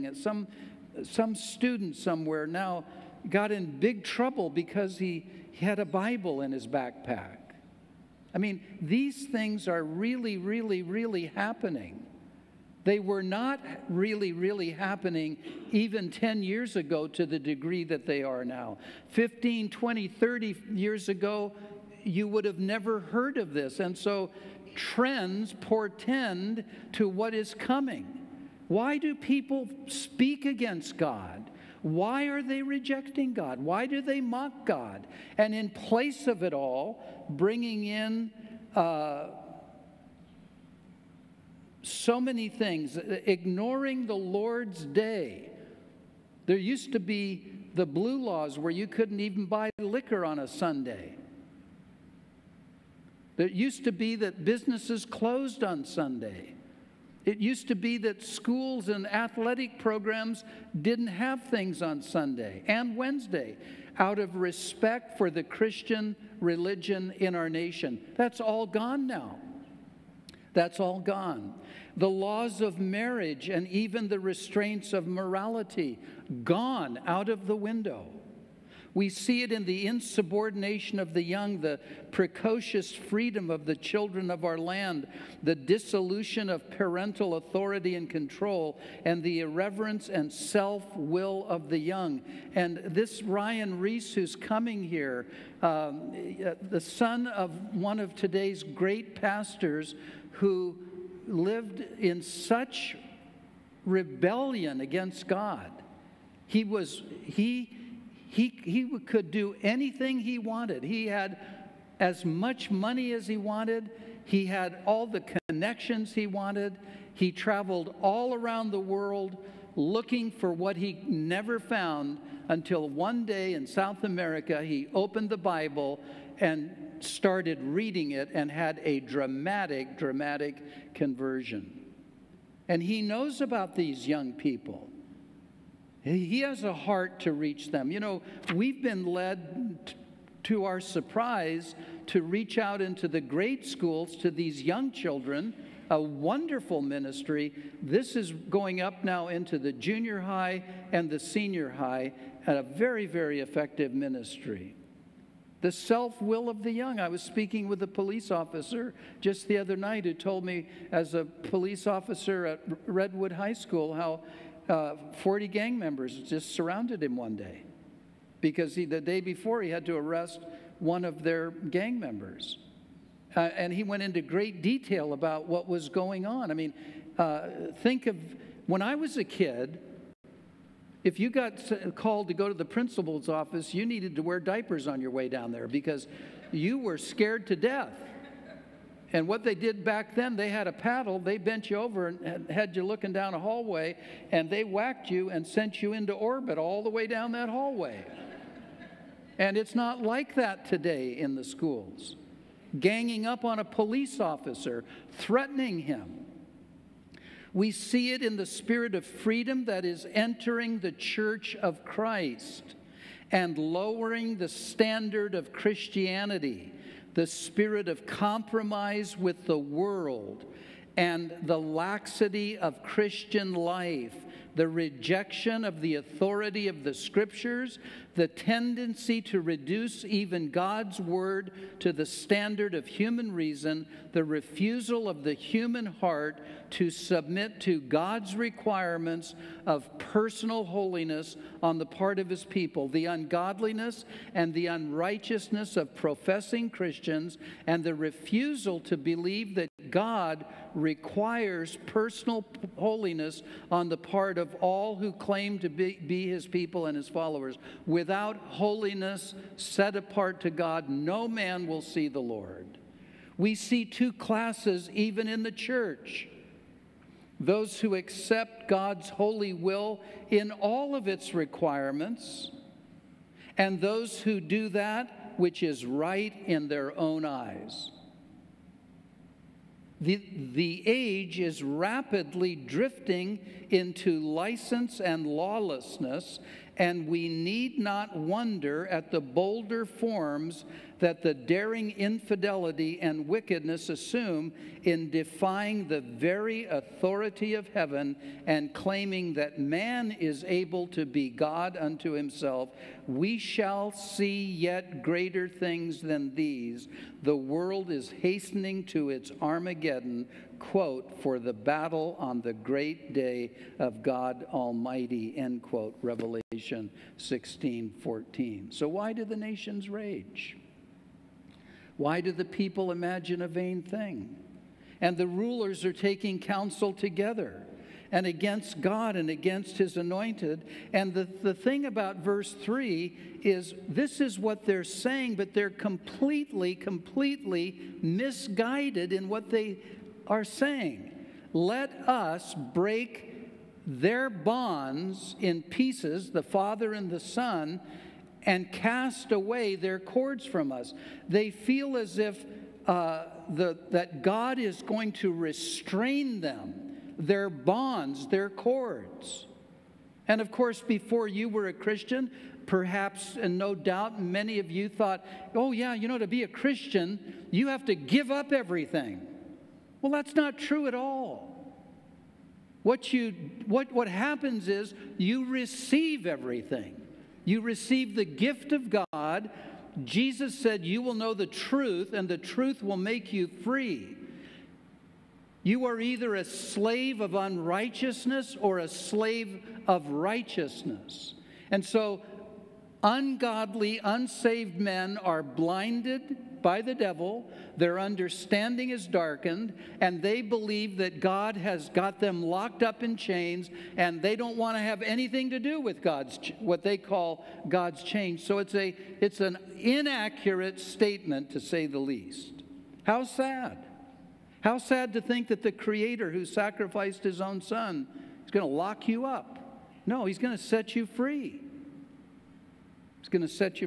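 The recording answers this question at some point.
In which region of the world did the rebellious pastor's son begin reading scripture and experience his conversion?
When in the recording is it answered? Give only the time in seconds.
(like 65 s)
123 s.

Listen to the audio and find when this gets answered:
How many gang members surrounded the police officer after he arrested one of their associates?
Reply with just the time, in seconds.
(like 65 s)
165 s.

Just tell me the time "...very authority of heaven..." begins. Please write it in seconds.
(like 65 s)
296 s.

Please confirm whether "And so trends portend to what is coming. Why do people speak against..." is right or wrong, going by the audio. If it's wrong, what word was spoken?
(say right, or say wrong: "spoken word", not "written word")
right.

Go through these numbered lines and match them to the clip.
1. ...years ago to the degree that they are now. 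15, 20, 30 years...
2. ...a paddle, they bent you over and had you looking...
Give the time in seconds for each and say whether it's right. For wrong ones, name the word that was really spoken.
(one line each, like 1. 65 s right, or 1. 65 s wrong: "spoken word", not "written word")
1. 16 s right
2. 190 s right.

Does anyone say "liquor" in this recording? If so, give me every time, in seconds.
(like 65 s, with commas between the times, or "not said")
49 s.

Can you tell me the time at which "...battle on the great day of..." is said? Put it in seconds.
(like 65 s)
311 s.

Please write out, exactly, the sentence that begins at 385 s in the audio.
You are either a slave of unrighteousness or a slave of righteousness.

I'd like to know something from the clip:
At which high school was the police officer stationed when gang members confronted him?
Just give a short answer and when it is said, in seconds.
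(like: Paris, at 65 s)
Redwood High School, at 162 s.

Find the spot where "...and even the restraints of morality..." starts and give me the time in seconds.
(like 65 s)
73 s.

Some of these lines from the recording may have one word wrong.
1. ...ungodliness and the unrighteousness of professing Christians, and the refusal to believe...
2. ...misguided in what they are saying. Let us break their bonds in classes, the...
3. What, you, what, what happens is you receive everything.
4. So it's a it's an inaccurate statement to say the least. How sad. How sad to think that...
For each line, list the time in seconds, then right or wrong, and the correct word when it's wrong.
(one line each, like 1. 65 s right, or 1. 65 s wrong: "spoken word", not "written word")
1. 243 s right
2. 338 s wrong: "pieces", not "classes"
3. 372 s right
4. 408 s right.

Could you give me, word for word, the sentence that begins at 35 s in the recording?
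And in place of it all, bringing in uh, so many things, ignoring the Lord's day.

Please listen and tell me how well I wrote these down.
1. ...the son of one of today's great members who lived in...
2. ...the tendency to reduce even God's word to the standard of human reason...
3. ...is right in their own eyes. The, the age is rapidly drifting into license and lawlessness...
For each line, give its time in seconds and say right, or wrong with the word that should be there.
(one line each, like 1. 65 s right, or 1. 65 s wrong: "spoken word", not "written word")
1. 96 s wrong: "pastors", not "members"
2. 228 s right
3. 275 s right.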